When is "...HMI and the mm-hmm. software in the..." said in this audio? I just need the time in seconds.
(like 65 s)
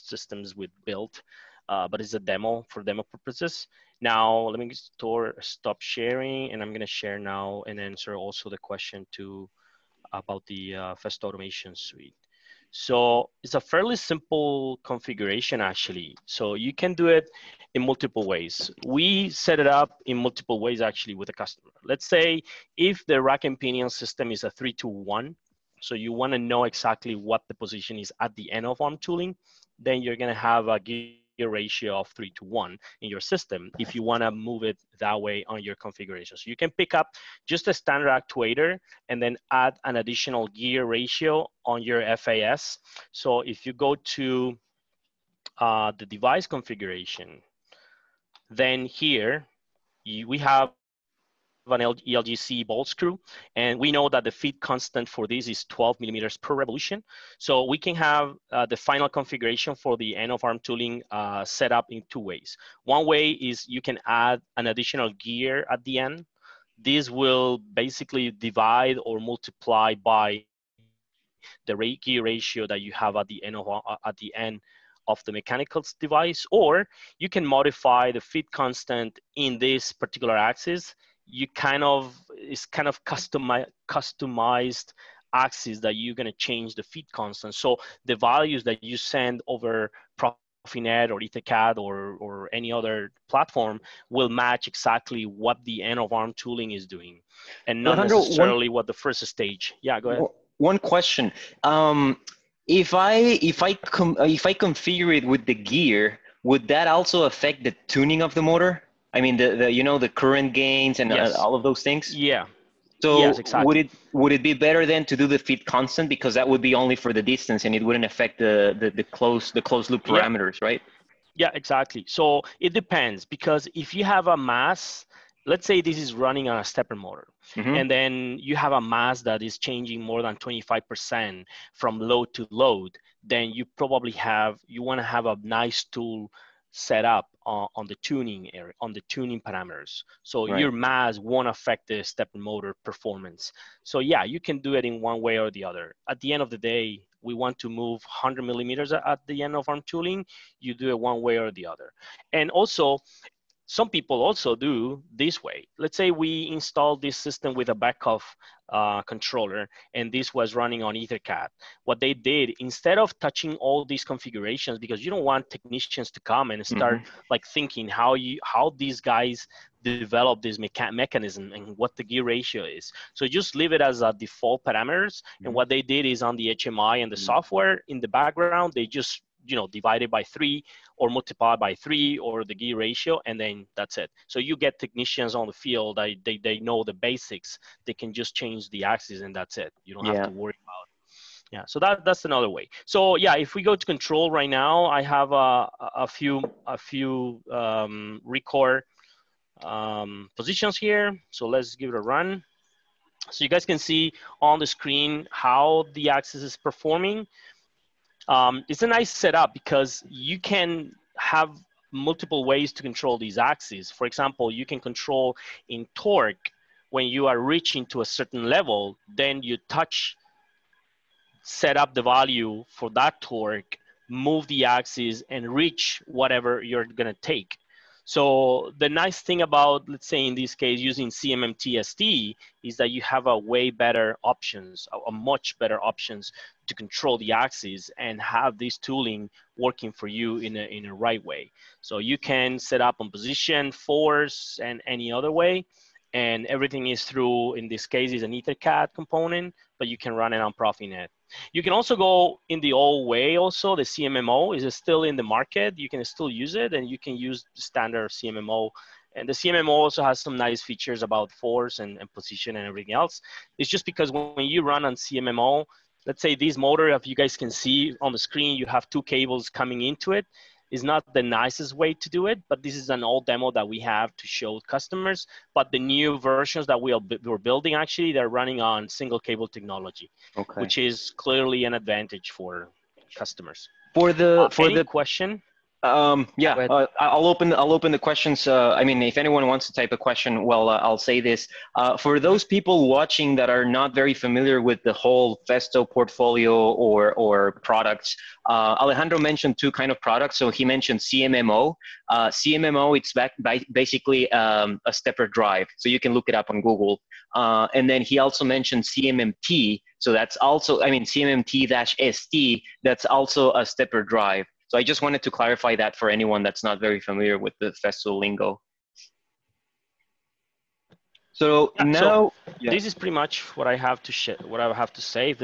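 176 s.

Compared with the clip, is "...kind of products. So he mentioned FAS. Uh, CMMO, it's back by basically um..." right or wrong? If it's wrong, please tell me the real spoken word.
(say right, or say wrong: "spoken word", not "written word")
wrong: "CMMO", not "FAS".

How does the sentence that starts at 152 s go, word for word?
And also, some people also do this way.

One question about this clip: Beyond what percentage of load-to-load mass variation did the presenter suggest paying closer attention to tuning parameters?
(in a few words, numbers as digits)
25%.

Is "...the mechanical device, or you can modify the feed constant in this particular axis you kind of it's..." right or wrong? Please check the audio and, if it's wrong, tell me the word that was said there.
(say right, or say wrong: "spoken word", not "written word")
right.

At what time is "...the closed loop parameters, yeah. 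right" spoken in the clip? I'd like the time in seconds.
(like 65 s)
119 s.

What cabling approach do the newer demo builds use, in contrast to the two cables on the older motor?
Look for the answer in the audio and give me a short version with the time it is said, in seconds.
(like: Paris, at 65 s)
Single cable technology, at 278 s.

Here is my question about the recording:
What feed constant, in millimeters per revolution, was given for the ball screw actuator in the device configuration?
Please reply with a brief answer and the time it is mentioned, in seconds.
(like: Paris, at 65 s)
12 millimeters per revolution, at 55 s.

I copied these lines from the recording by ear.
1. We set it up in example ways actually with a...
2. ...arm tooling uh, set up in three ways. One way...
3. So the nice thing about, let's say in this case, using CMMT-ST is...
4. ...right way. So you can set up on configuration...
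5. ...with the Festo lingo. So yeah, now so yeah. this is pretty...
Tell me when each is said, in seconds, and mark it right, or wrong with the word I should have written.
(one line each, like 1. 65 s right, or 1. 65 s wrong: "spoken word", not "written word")
1. 18 s wrong: "multiple", not "example"
2. 60 s wrong: "two", not "three"
3. 228 s right
4. 240 s wrong: "position", not "configuration"
5. 317 s right.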